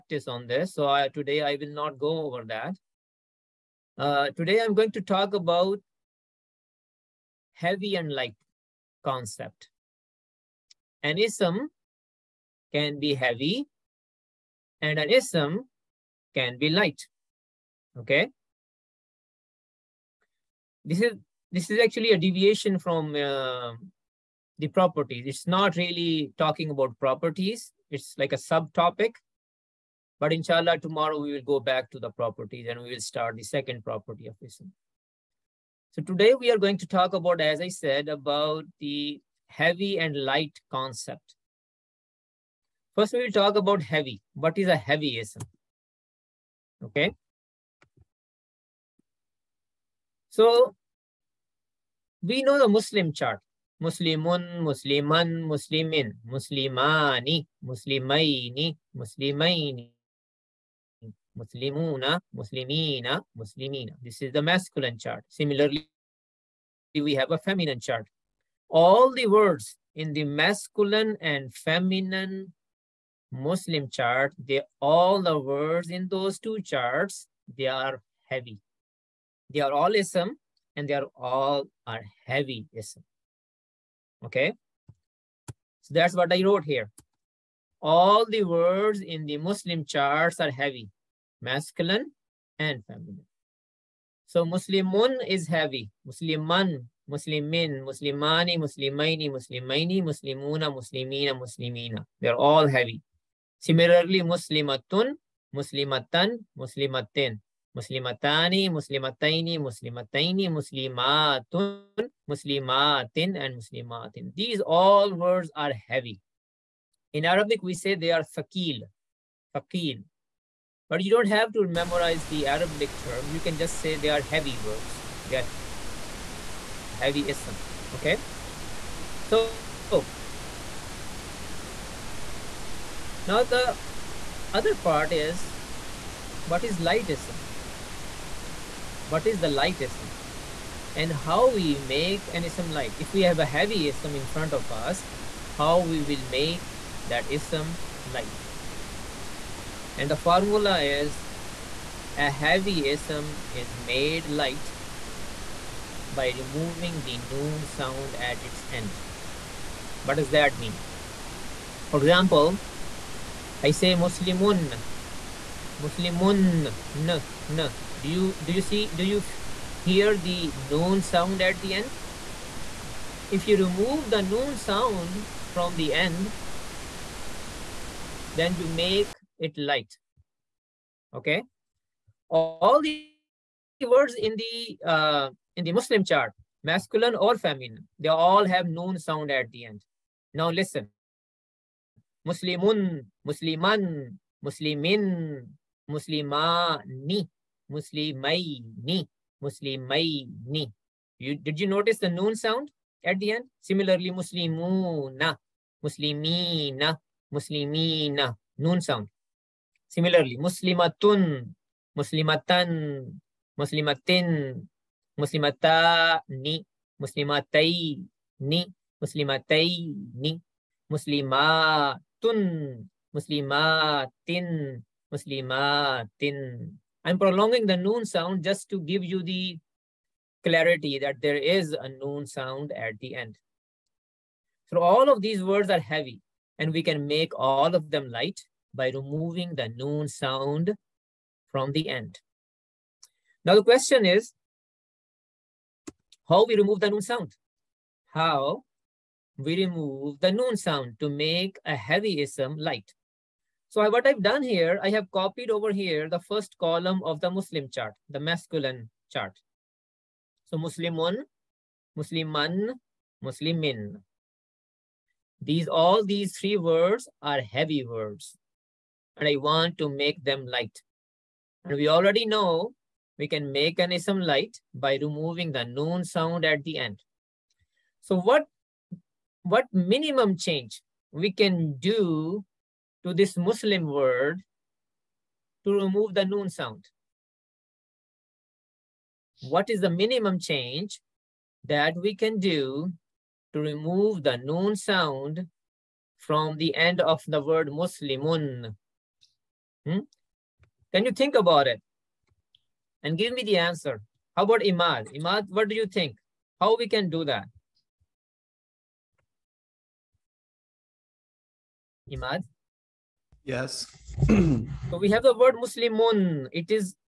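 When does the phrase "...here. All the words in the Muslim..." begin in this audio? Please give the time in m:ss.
1:26.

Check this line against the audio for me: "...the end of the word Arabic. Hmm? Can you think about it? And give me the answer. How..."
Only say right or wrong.
wrong.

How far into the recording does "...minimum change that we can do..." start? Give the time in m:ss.
4:49.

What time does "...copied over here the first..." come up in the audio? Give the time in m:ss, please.
4:15.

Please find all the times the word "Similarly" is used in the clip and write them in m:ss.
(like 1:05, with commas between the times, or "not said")
1:05, 1:43, 3:23, 3:29.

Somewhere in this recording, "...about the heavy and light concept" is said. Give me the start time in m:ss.
0:38.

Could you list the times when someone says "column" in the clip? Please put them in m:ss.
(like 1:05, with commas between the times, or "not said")
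4:16.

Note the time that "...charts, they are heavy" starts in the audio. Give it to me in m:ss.
1:16.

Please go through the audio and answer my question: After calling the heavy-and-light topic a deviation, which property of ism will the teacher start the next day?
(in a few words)
second property.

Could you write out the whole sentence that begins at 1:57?
In Arabic, we say they are thaqil, thaqil, but you don't have to memorize the Arabic term.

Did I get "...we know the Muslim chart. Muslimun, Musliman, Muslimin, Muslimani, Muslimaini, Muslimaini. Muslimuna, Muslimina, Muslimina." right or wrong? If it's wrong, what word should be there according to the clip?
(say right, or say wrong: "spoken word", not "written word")
right.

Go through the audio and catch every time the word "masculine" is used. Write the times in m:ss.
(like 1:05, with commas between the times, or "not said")
1:04, 1:10, 1:31, 3:06, 4:18.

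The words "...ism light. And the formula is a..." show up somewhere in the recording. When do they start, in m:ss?
2:27.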